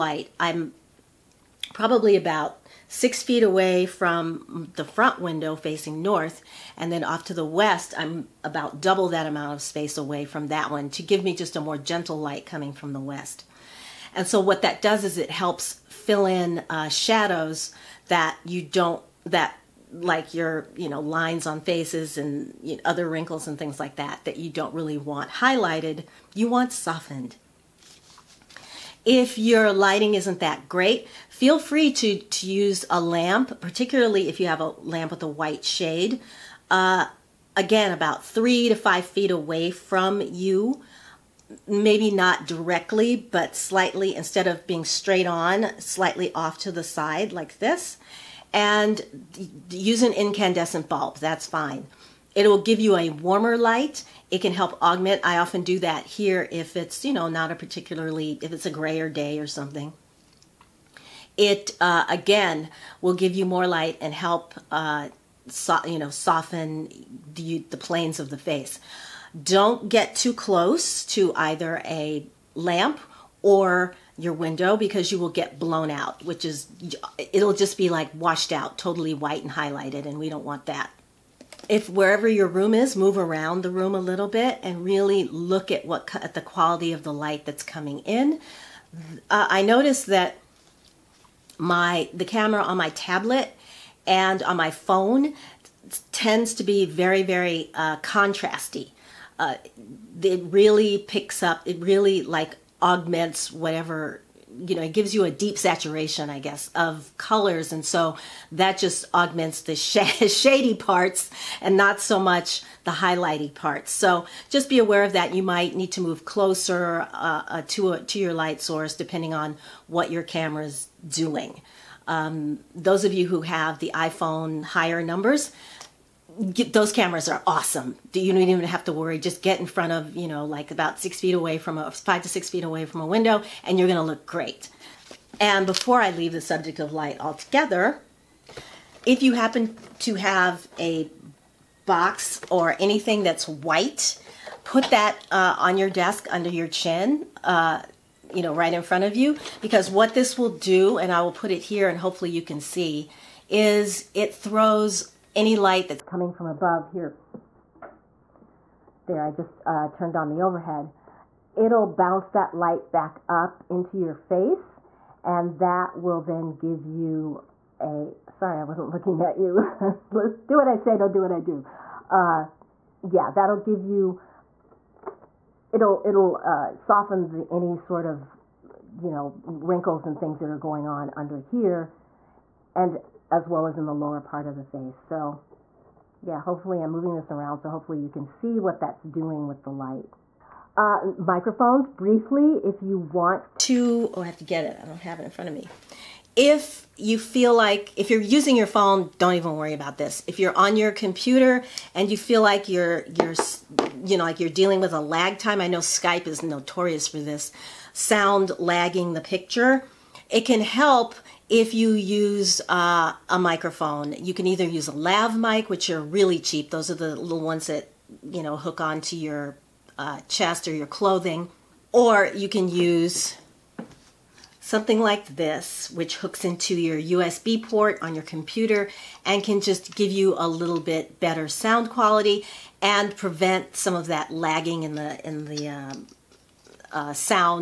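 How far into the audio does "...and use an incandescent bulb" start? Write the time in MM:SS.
00:48.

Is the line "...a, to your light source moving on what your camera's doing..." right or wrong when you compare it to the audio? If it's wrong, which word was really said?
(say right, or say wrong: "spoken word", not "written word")
wrong: "depending", not "moving".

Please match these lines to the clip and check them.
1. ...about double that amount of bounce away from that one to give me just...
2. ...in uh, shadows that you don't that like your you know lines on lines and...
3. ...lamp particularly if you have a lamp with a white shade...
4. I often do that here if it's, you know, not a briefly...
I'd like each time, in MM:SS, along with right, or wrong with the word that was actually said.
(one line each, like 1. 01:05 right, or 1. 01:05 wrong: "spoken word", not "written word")
1. 00:08 wrong: "space", not "bounce"
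2. 00:16 wrong: "faces", not "lines"
3. 00:33 right
4. 00:55 wrong: "particularly", not "briefly".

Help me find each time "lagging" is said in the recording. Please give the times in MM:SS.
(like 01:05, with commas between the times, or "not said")
03:28, 03:54.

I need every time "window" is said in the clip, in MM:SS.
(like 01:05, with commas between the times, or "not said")
00:05, 01:14, 02:13.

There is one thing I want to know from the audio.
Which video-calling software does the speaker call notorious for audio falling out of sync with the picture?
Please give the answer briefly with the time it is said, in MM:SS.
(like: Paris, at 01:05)
Skype, at 03:25.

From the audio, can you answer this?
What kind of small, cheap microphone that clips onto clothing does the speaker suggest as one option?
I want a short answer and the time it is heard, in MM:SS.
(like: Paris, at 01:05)
lav mic, at 03:34.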